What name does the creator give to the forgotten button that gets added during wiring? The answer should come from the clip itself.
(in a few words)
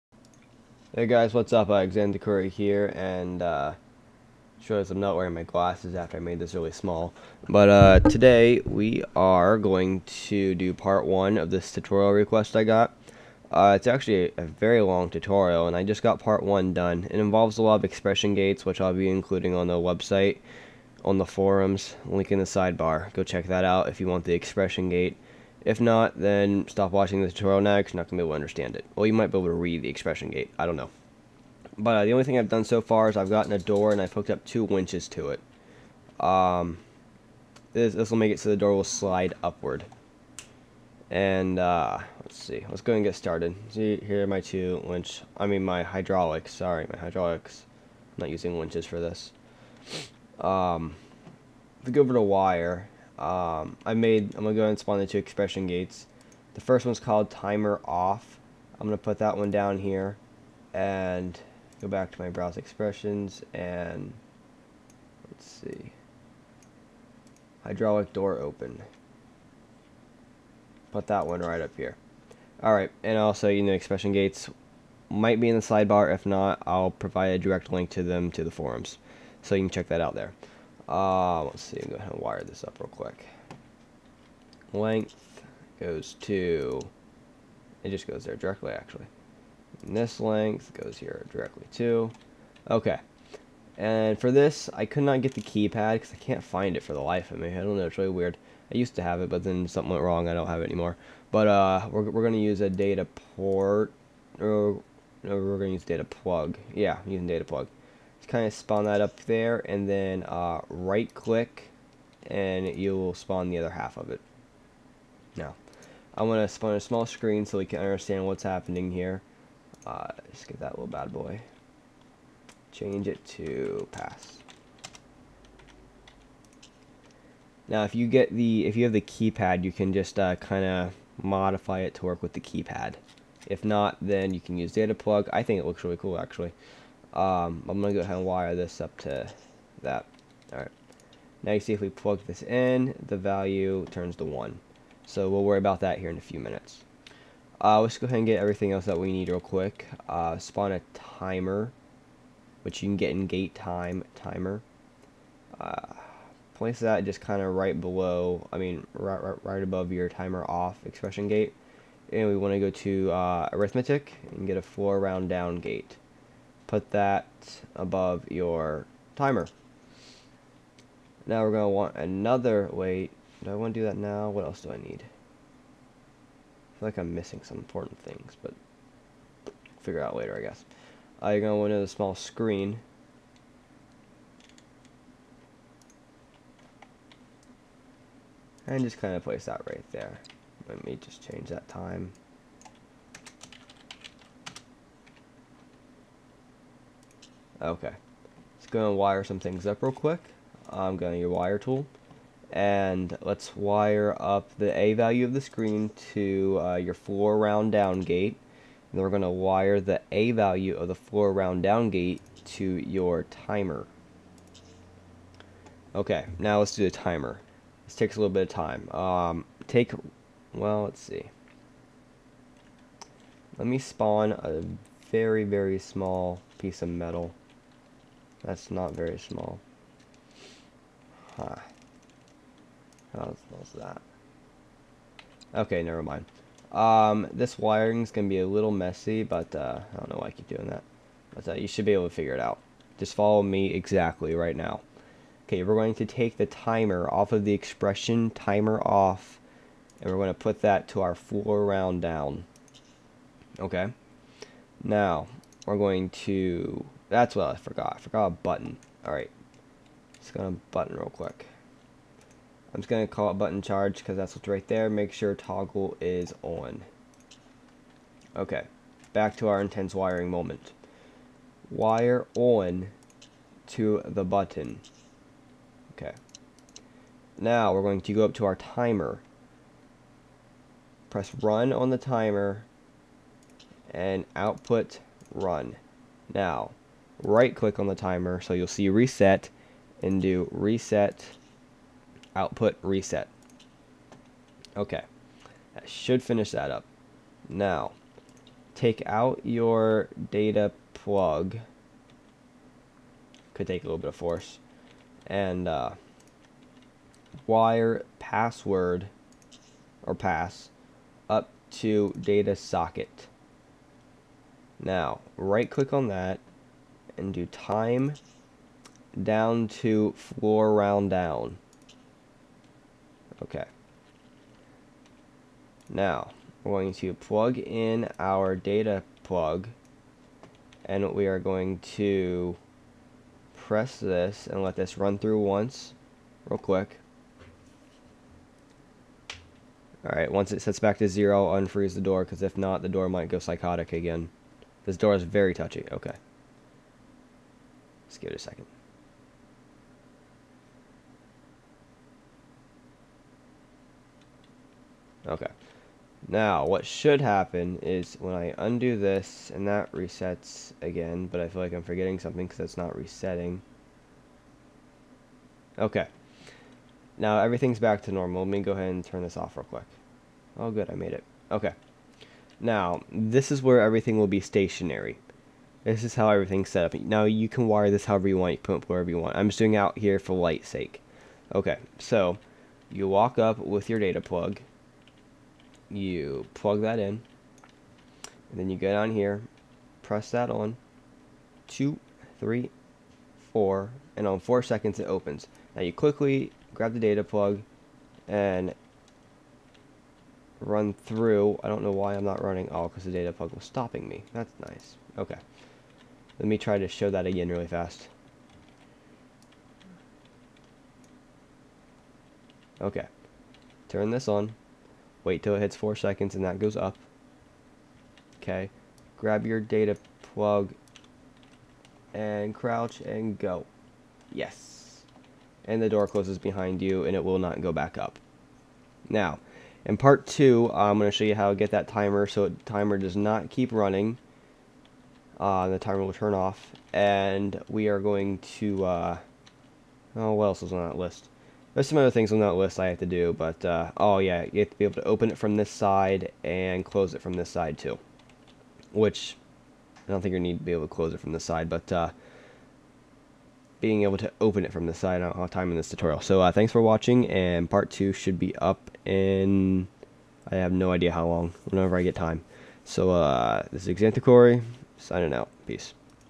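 Button charge.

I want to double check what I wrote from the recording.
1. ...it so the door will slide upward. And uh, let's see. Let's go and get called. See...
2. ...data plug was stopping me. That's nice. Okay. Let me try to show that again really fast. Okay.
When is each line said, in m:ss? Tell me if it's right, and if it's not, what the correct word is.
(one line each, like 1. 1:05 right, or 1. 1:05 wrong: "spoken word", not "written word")
1. 0:38 wrong: "started", not "called"
2. 6:43 right.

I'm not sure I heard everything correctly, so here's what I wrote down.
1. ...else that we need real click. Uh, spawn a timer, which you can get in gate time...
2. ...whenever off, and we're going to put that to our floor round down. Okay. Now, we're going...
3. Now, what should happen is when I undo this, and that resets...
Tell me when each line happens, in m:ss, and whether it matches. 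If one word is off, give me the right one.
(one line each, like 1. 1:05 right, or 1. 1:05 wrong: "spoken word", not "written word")
1. 2:28 wrong: "quick", not "click"
2. 4:08 wrong: "timer", not "whenever"
3. 5:56 right.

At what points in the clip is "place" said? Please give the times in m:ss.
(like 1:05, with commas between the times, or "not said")
2:36, 3:09.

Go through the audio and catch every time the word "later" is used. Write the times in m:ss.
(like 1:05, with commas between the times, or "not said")
3:00.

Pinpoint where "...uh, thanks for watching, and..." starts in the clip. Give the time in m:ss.
7:36.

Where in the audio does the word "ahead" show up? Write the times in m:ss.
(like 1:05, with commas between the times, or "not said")
2:18, 2:28, 6:08.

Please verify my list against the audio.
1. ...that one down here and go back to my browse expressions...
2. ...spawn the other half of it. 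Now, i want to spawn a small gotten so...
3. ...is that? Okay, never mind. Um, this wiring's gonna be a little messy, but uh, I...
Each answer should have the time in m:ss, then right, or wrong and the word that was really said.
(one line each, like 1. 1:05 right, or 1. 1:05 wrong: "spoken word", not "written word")
1. 0:59 right
2. 1:53 wrong: "screen", not "gotten"
3. 3:53 right.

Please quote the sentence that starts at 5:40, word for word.
Alright, once it sets back to zero, unfreeze the door because if not, the door might go psychotic again.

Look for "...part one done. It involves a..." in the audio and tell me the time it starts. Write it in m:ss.
0:16.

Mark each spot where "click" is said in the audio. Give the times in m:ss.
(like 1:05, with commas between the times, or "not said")
1:51, 4:47, 5:15.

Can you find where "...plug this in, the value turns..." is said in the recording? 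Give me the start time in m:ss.
2:21.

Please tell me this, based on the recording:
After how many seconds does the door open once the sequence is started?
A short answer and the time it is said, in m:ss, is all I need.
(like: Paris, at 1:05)
4, at 6:34.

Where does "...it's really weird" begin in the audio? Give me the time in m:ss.
1:37.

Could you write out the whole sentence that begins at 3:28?
And then we're going to wire the A value of the floor round down gate to your timer.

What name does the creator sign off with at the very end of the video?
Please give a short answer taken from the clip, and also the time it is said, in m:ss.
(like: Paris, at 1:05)
Xanthicory, at 7:43.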